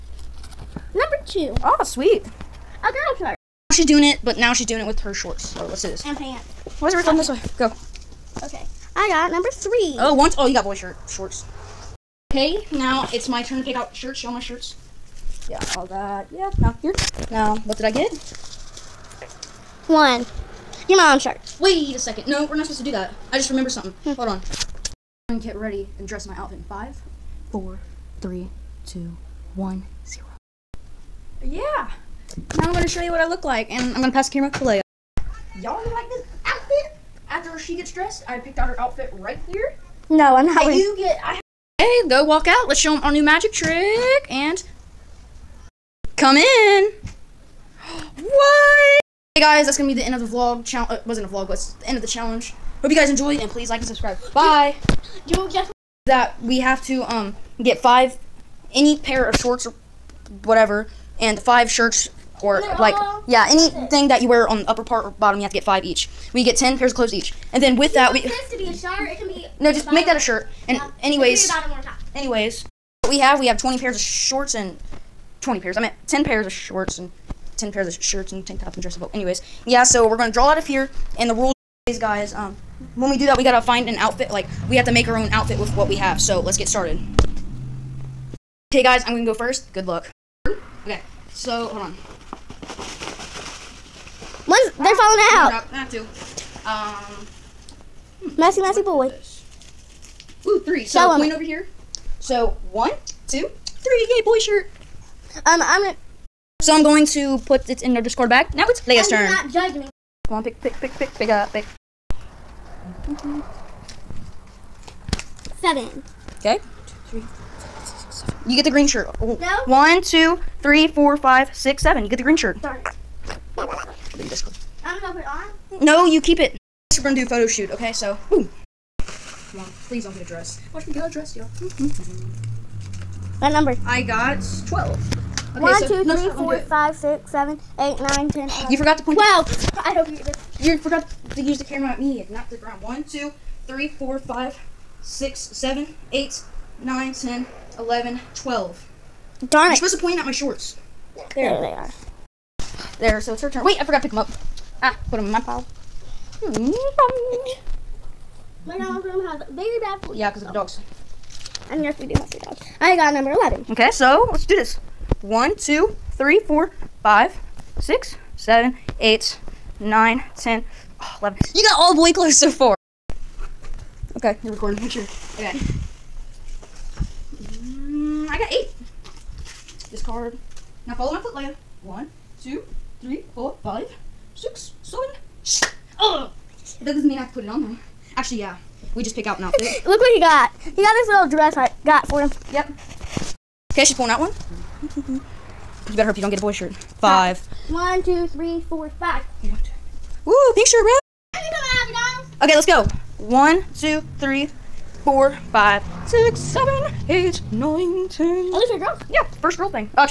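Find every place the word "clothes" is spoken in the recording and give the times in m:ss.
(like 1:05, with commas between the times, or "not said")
1:06, 2:52.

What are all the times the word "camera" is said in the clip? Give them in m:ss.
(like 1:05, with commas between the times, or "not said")
0:34, 2:21.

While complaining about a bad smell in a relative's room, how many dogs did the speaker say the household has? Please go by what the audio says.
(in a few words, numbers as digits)
3.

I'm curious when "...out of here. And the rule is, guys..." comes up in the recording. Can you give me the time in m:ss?
1:20.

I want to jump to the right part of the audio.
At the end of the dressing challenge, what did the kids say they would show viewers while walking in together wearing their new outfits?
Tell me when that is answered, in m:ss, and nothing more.
0:43.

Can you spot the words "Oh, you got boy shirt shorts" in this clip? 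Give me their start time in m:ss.
0:10.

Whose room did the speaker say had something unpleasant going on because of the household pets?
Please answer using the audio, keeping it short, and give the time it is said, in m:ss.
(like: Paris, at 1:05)
Grandma's room, at 2:38.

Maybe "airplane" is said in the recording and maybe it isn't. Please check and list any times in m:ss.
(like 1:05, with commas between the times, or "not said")
not said.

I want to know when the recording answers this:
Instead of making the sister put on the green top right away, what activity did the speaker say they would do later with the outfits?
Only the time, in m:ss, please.
2:07.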